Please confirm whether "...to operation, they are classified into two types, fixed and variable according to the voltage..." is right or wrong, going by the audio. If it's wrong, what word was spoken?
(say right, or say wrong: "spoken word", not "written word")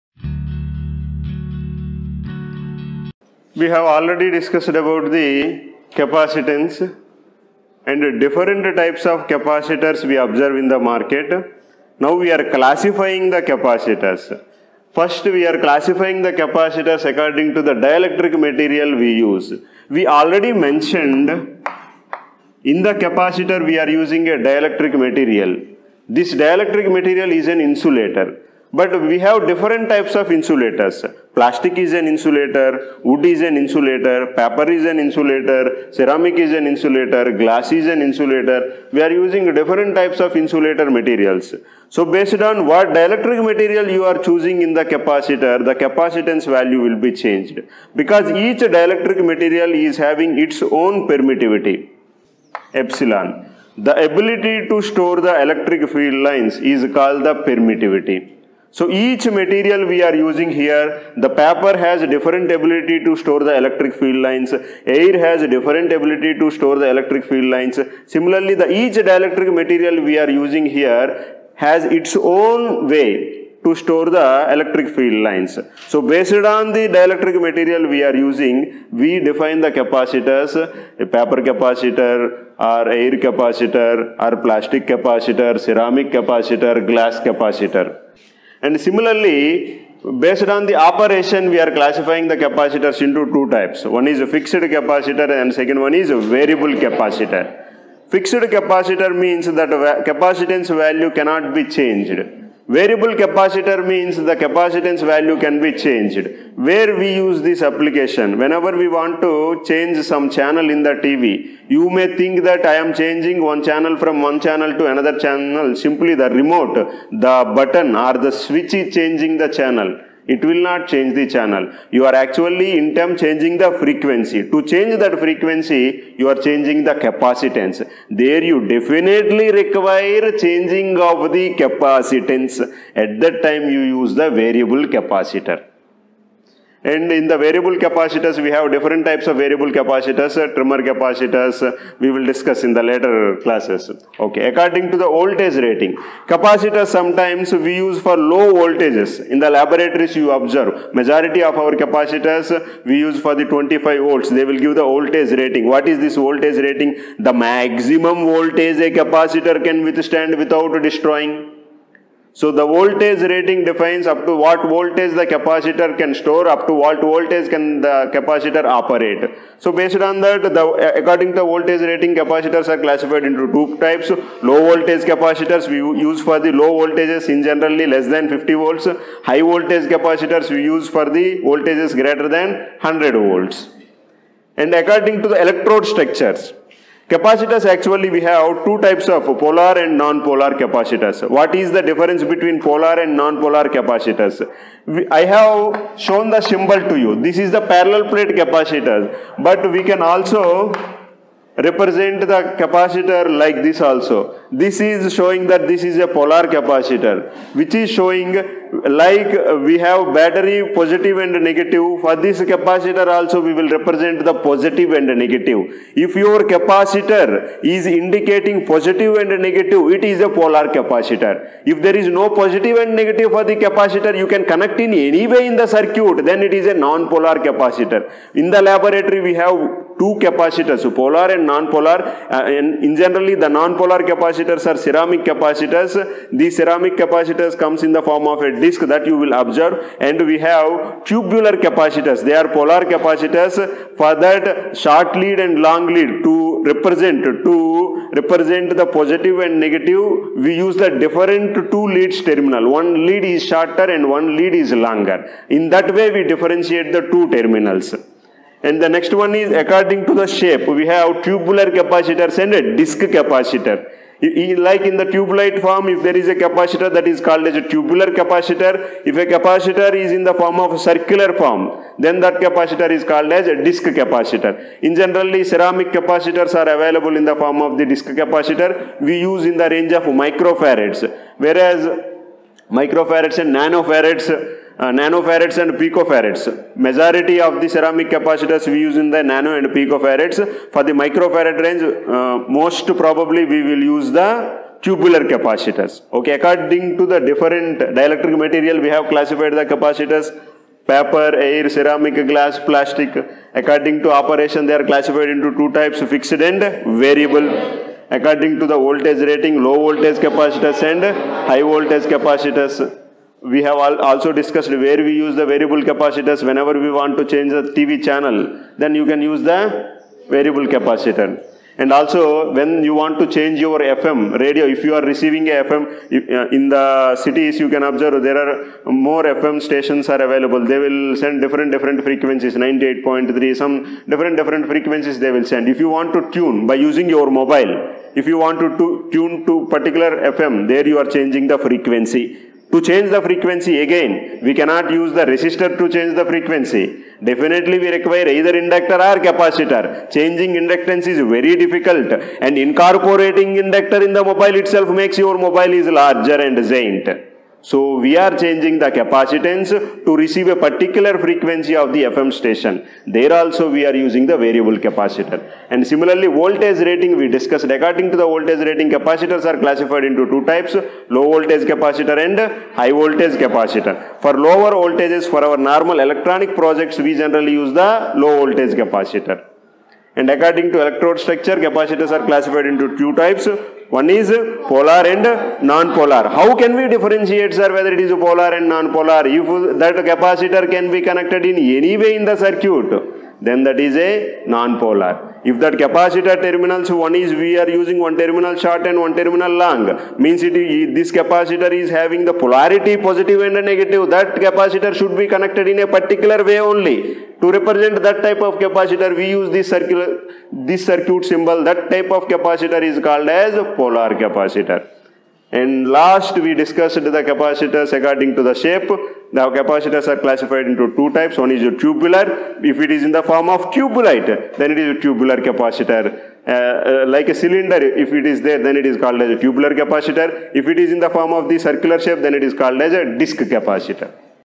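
right.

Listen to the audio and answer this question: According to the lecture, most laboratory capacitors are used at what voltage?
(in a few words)
25 volts.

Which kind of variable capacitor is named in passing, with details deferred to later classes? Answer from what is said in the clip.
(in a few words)
Trimmer capacitors.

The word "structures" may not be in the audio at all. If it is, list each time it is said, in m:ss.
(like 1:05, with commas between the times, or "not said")
3:05, 6:21.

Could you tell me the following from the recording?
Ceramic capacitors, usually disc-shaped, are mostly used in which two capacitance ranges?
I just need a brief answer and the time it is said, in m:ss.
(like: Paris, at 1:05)
Nano and picofarads, at 4:49.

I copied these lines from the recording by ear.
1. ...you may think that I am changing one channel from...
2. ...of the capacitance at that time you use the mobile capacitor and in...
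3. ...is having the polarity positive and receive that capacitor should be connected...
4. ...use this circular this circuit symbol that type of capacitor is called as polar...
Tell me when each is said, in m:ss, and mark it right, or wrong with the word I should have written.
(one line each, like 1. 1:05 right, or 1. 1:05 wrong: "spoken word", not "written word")
1. 1:51 right
2. 2:11 wrong: "variable", not "mobile"
3. 6:41 wrong: "negative", not "receive"
4. 6:49 right.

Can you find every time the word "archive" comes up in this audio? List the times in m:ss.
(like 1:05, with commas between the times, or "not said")
not said.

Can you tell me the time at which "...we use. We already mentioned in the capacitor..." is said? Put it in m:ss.
0:18.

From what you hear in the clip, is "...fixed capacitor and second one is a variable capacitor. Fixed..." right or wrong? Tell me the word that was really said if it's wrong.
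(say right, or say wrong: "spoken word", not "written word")
right.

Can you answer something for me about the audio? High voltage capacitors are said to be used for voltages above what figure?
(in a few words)
100 volts.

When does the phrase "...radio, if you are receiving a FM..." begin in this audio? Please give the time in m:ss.
5:24.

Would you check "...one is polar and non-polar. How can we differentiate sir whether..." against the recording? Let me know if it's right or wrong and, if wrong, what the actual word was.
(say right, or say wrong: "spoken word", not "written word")
right.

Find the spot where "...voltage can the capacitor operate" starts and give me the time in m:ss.
2:47.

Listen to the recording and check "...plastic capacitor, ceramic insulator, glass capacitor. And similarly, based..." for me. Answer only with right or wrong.
wrong.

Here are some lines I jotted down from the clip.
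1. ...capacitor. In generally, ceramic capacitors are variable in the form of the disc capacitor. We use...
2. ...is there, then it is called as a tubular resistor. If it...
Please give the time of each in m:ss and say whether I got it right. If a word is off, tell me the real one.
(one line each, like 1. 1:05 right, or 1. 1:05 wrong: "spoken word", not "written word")
1. 4:33 wrong: "available", not "variable"
2. 7:08 wrong: "capacitor", not "resistor".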